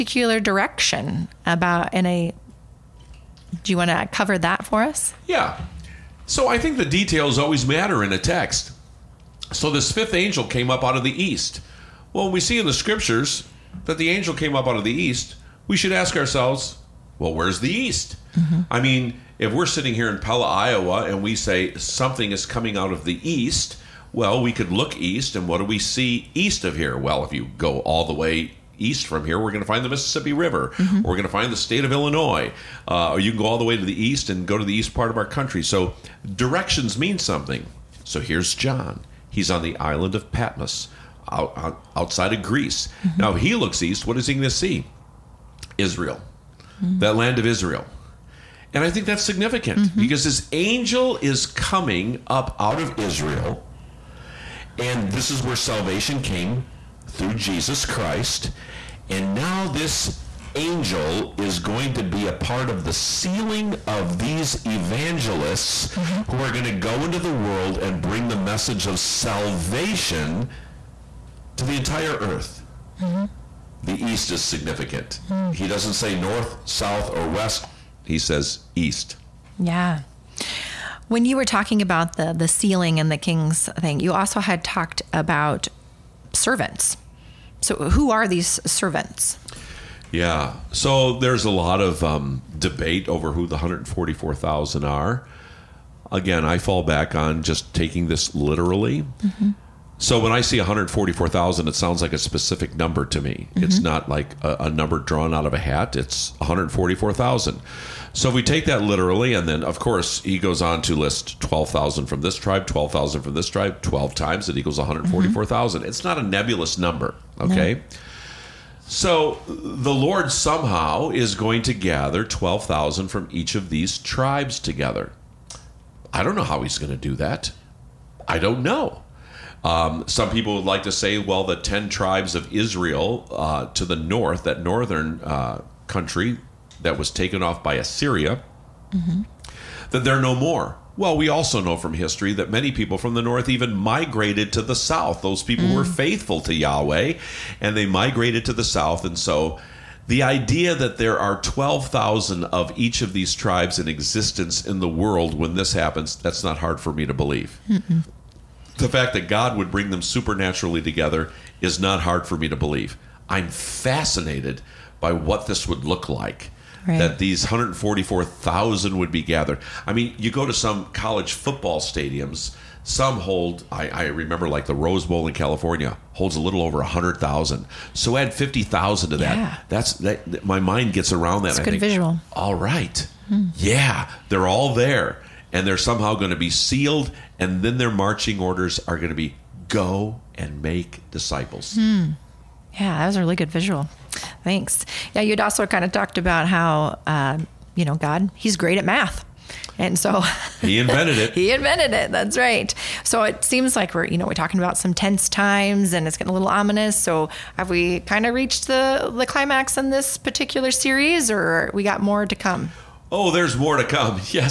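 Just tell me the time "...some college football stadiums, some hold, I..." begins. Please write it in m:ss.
2:50.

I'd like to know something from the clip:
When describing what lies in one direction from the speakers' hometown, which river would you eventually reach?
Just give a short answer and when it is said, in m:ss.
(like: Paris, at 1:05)
Mississippi River, at 0:29.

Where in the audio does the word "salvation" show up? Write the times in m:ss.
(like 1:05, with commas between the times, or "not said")
0:55, 1:08.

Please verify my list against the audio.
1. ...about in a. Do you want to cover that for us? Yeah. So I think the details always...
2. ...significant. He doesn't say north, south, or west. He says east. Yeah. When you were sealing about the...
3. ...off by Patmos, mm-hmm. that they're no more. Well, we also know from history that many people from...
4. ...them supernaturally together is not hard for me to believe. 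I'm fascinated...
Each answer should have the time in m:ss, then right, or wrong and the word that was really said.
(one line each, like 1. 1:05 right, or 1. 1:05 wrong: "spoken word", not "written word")
1. 0:01 right
2. 1:14 wrong: "talking", not "sealing"
3. 2:17 wrong: "Assyria", not "Patmos"
4. 2:39 right.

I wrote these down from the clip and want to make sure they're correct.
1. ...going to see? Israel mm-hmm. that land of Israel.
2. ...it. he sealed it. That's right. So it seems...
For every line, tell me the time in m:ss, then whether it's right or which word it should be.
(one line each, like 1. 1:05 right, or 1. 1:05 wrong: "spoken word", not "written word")
1. 0:44 right
2. 3:21 wrong: "invented", not "sealed".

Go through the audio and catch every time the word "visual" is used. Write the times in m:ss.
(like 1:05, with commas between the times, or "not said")
3:01, 3:13.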